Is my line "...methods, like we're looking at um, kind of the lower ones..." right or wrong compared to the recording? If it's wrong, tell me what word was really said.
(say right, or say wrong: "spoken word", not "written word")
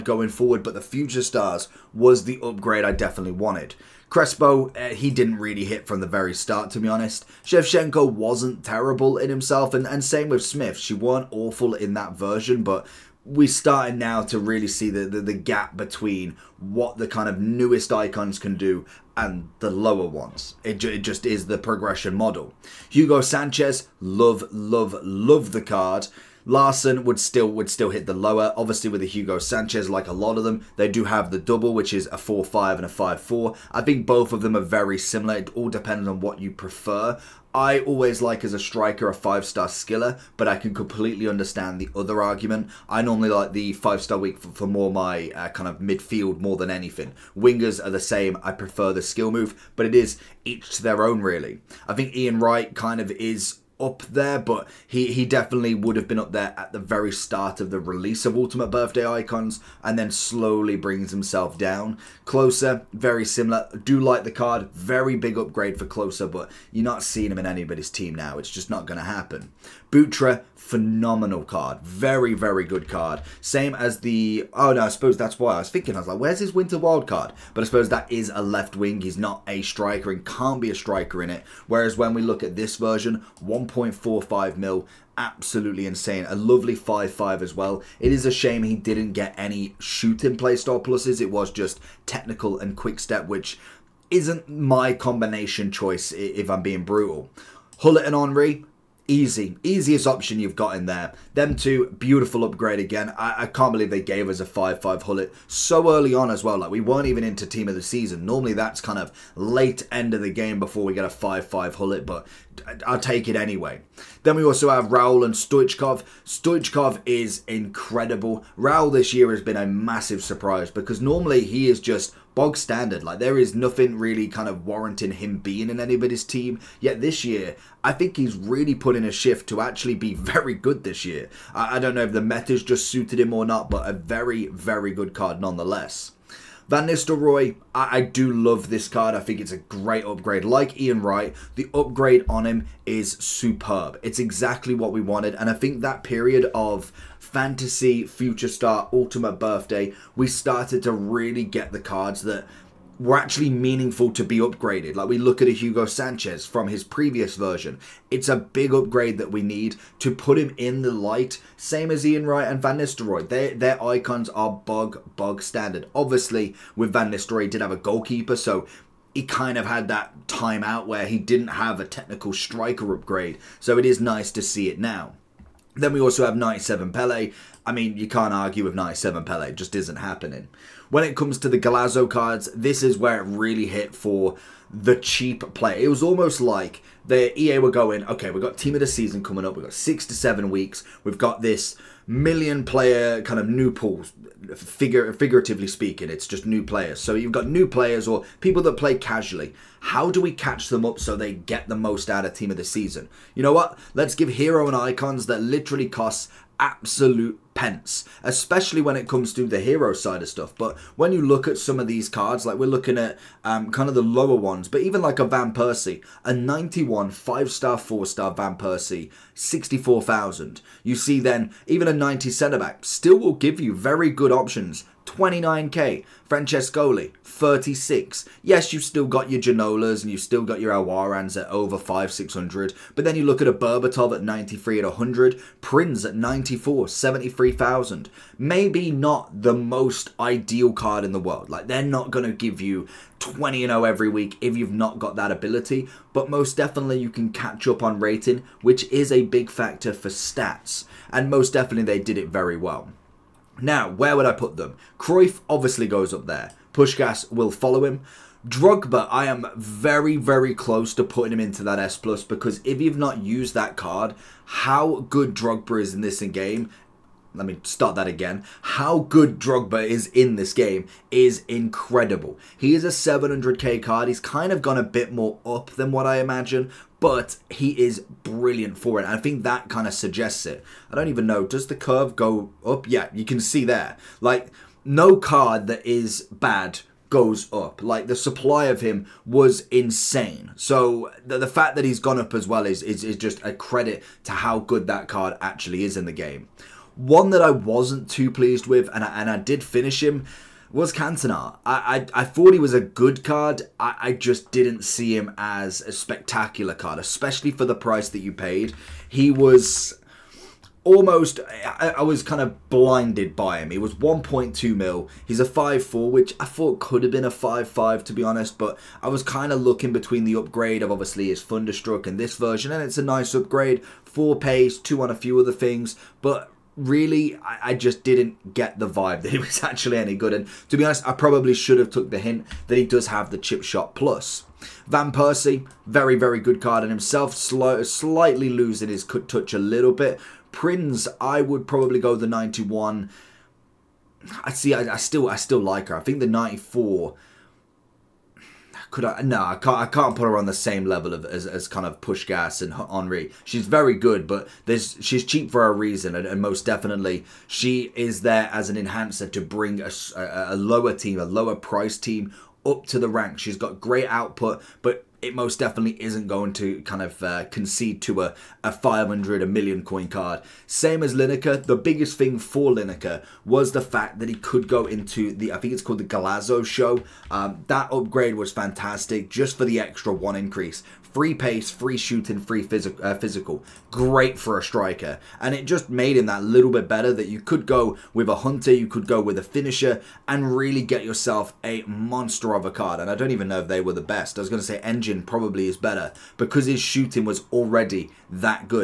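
wrong: "cards", not "methods".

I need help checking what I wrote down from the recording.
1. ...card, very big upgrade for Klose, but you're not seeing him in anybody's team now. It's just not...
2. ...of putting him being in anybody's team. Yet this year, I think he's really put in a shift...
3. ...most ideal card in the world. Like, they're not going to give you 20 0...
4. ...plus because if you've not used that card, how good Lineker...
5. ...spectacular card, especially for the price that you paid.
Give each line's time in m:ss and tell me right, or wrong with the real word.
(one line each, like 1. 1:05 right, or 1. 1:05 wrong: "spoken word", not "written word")
1. 1:04 right
2. 2:04 wrong: "warranting", not "putting"
3. 3:59 right
4. 4:21 wrong: "Drogba", not "Lineker"
5. 5:05 right.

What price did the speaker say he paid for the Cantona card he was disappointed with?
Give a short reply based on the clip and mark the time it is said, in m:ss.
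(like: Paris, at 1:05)
1.2 million, at 5:13.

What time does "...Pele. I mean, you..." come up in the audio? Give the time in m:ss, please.
2:56.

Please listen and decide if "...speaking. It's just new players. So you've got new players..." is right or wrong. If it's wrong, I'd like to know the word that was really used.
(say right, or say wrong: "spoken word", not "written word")
right.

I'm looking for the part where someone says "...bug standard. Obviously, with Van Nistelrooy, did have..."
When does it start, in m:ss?
2:45.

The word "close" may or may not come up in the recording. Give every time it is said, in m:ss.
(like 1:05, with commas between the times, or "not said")
4:20.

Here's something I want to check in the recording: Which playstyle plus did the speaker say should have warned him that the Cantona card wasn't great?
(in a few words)
Chip Shot Plus.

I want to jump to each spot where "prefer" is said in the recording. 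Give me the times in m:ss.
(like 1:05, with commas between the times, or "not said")
0:36, 0:48.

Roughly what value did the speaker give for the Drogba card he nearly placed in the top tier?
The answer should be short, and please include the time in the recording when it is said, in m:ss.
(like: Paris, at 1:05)
700k, at 4:32.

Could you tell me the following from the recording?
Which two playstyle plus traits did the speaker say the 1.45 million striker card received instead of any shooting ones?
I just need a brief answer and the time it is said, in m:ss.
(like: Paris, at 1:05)
Technical and Quick Step, at 1:32.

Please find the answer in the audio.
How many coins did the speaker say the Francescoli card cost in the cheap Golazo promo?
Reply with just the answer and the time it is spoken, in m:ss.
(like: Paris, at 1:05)
36,000, at 3:47.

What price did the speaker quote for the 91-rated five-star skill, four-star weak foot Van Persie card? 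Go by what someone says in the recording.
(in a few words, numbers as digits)
64,000.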